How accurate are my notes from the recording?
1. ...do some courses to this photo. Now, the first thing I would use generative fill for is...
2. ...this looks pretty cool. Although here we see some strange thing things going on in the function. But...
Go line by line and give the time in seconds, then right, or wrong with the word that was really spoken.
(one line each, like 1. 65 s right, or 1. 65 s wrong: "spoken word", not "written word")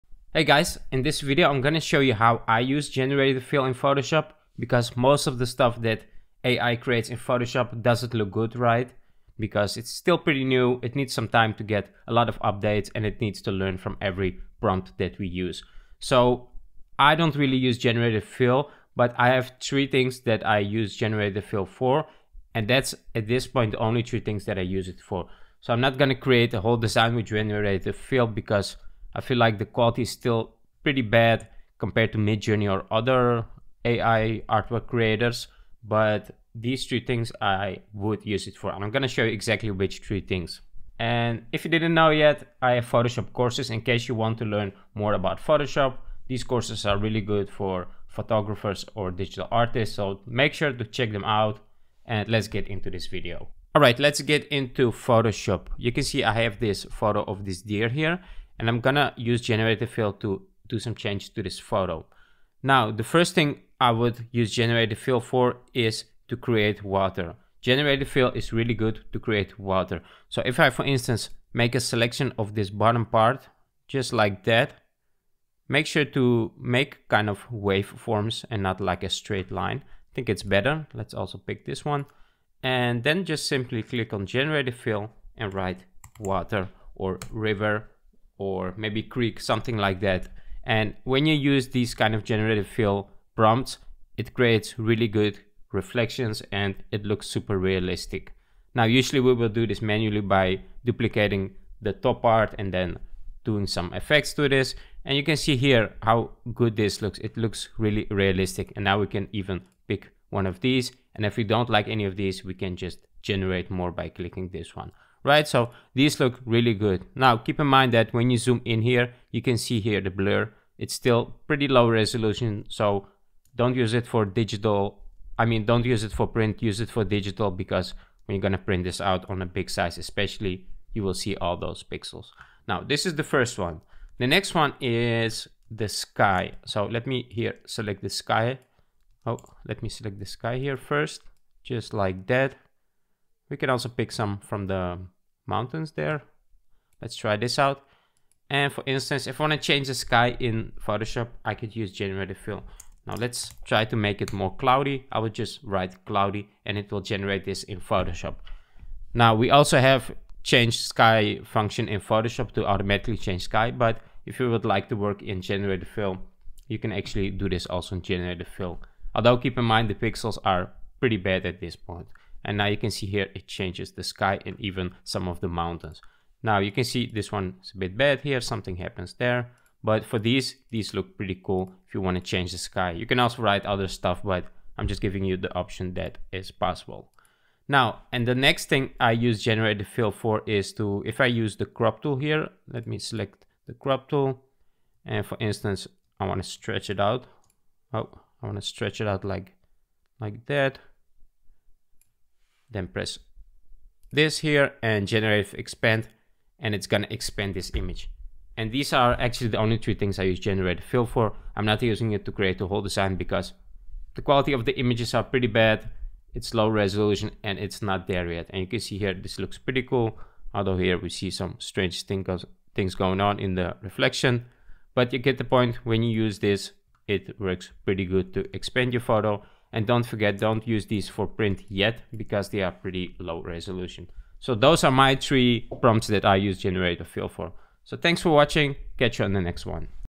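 1. 60 s wrong: "changes", not "courses"
2. 219 s wrong: "reflection", not "function".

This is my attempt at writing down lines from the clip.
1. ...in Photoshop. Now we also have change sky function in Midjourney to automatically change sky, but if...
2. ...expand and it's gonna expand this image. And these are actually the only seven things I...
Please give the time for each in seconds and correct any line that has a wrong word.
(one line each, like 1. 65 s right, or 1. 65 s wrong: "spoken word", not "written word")
1. 157 s wrong: "Photoshop", not "Midjourney"
2. 205 s wrong: "three", not "seven".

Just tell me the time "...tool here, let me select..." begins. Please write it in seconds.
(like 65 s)
192 s.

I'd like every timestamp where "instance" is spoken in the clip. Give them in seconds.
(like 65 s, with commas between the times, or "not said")
70 s, 148 s, 195 s.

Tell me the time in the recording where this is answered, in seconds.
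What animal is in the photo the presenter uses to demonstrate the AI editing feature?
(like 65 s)
57 s.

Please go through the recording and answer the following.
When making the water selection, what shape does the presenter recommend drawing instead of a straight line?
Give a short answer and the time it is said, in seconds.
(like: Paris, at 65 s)
Waveforms, at 77 s.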